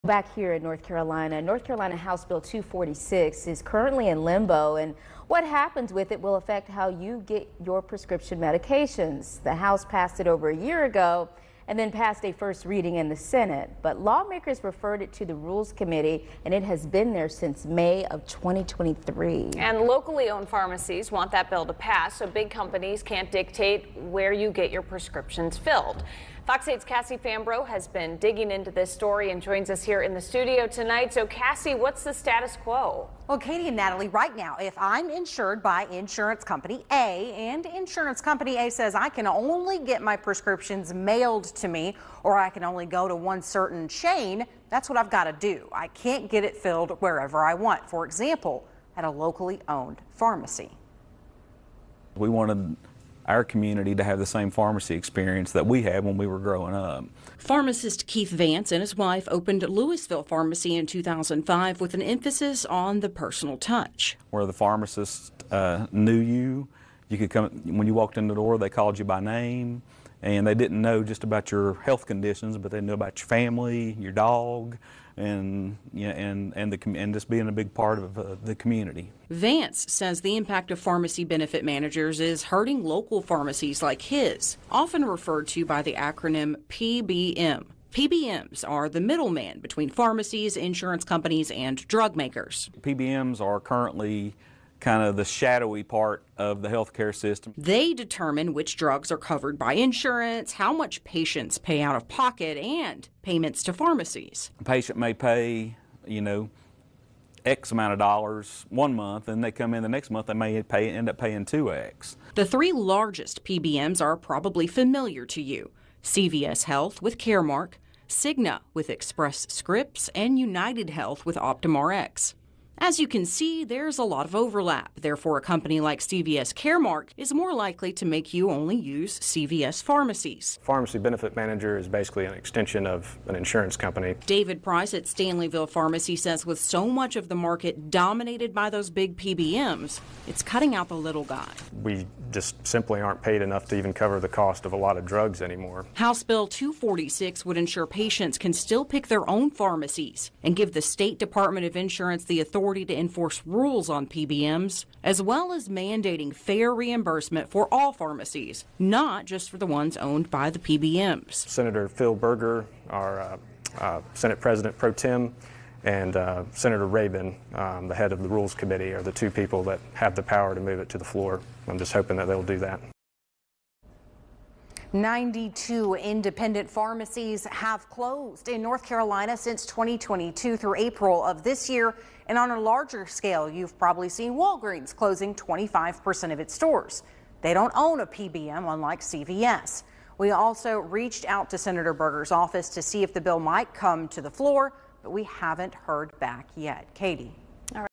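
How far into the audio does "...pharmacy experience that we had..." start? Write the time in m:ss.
0:54.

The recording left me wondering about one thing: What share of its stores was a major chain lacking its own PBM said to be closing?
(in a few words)
25%.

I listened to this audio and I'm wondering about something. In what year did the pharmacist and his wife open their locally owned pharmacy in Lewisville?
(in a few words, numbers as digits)
2005.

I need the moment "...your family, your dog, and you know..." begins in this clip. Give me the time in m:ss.
1:13.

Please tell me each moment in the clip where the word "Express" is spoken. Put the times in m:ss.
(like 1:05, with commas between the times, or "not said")
1:58.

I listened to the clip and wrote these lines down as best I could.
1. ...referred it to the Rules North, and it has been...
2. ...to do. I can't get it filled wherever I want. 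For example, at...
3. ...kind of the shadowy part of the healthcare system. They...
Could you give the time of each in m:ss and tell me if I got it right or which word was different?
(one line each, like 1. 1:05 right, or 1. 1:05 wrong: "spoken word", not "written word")
1. 0:14 wrong: "Committee", not "North"
2. 0:45 right
3. 1:34 right.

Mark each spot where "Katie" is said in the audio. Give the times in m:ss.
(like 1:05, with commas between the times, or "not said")
0:33, 3:16.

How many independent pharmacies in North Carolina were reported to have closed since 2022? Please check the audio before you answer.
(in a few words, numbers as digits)
92.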